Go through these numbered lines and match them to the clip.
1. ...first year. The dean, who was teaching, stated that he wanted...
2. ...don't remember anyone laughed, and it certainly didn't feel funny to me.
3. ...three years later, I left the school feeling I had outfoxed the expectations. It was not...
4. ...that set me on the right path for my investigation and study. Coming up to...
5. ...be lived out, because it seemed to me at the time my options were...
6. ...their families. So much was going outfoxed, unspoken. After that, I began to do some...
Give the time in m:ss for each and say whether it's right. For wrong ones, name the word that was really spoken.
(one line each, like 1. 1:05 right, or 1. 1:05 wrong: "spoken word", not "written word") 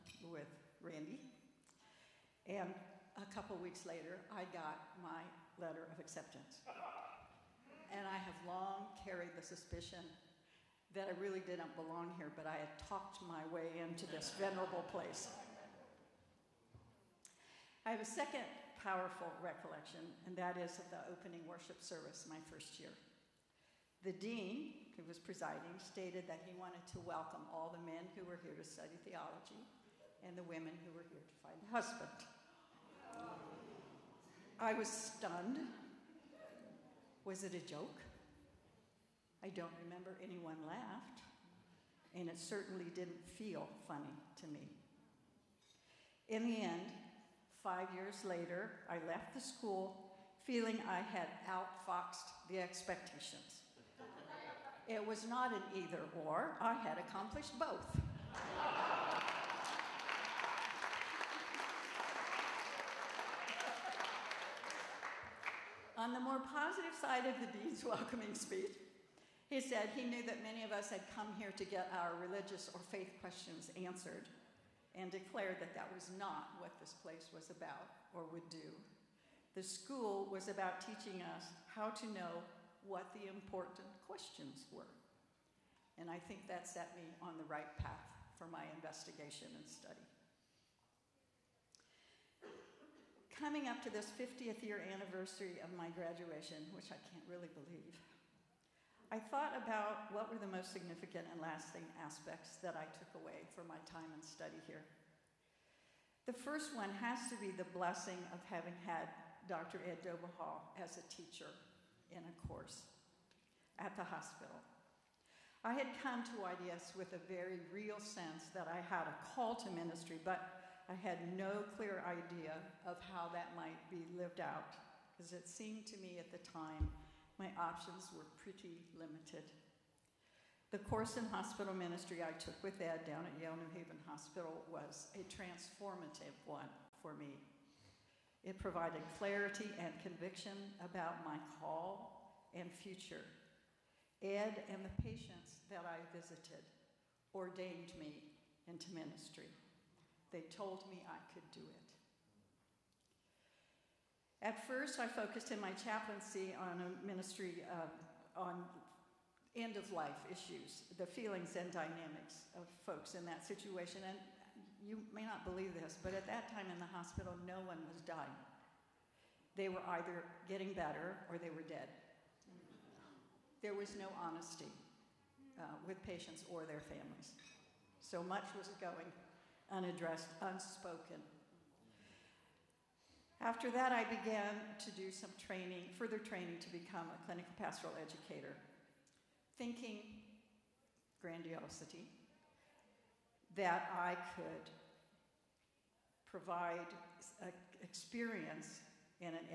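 1. 0:22 wrong: "presiding", not "teaching"
2. 0:39 right
3. 0:47 wrong: "five", not "three"
4. 1:26 right
5. 2:03 right
6. 2:56 wrong: "unaddressed", not "outfoxed".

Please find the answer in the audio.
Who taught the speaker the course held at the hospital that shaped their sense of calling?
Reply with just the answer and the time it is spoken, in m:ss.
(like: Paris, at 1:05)
Dr. Ed Dobihal, at 1:49.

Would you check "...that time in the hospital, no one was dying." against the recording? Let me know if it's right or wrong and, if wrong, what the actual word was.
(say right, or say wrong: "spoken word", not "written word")
right.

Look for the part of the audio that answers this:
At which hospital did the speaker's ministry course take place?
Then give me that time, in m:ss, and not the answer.
2:13.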